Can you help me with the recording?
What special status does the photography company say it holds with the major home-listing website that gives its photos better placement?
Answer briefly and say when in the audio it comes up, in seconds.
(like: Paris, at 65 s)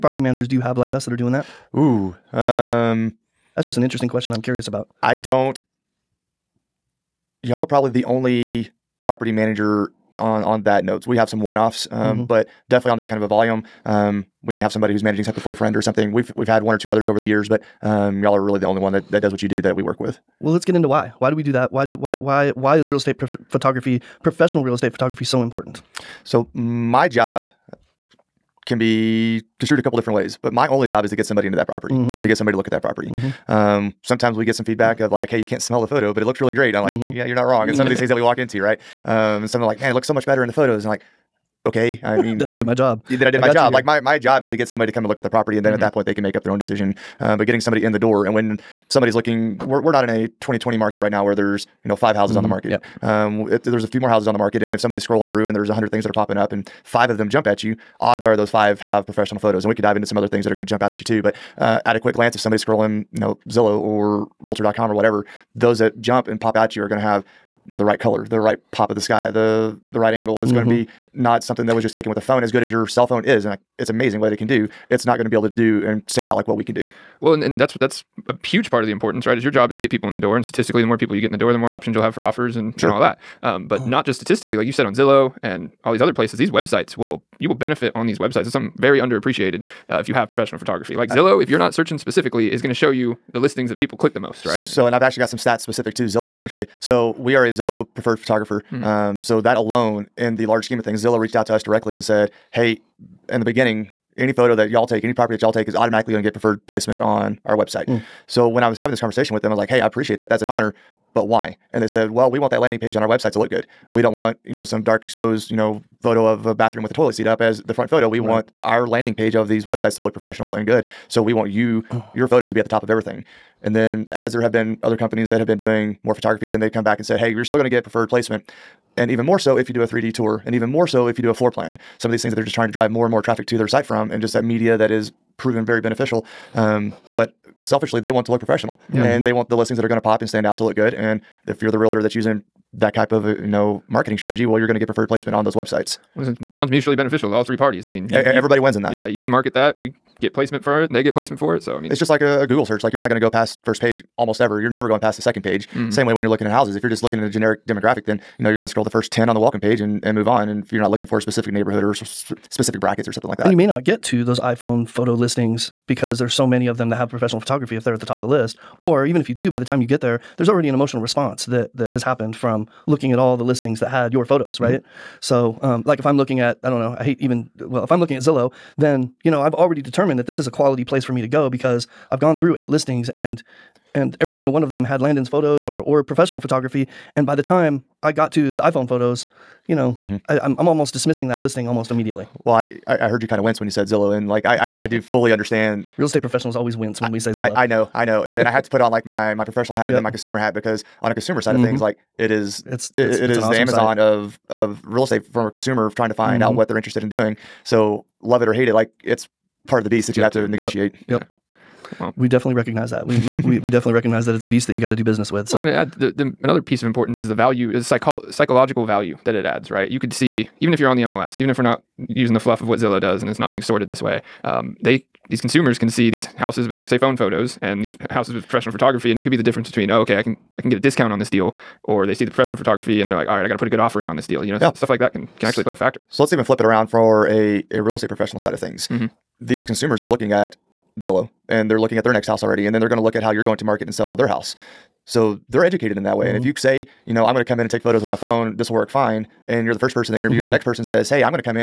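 Zillow preferred photographer, at 97 s.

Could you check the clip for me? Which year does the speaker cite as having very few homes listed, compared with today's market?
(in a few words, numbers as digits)
2020.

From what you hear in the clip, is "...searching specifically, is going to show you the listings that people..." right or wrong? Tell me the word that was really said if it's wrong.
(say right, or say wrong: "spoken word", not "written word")
right.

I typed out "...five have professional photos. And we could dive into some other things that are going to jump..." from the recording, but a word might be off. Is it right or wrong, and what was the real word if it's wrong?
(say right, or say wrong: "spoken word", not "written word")
right.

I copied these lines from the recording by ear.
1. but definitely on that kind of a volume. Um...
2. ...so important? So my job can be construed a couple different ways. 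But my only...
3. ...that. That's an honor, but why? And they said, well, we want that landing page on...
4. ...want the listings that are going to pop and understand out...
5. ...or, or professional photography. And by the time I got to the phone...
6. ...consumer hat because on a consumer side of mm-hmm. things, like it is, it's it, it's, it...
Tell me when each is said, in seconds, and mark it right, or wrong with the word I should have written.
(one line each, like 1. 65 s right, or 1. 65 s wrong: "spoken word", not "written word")
1. 12 s right
2. 25 s right
3. 110 s right
4. 139 s wrong: "stand", not "understand"
5. 185 s wrong: "iPhone", not "phone"
6. 200 s right.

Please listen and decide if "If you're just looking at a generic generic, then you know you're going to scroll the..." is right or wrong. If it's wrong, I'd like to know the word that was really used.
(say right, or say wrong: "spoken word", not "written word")
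wrong: "demographic", not "generic".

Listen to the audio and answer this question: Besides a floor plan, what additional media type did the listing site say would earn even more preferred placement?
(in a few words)
3D tour.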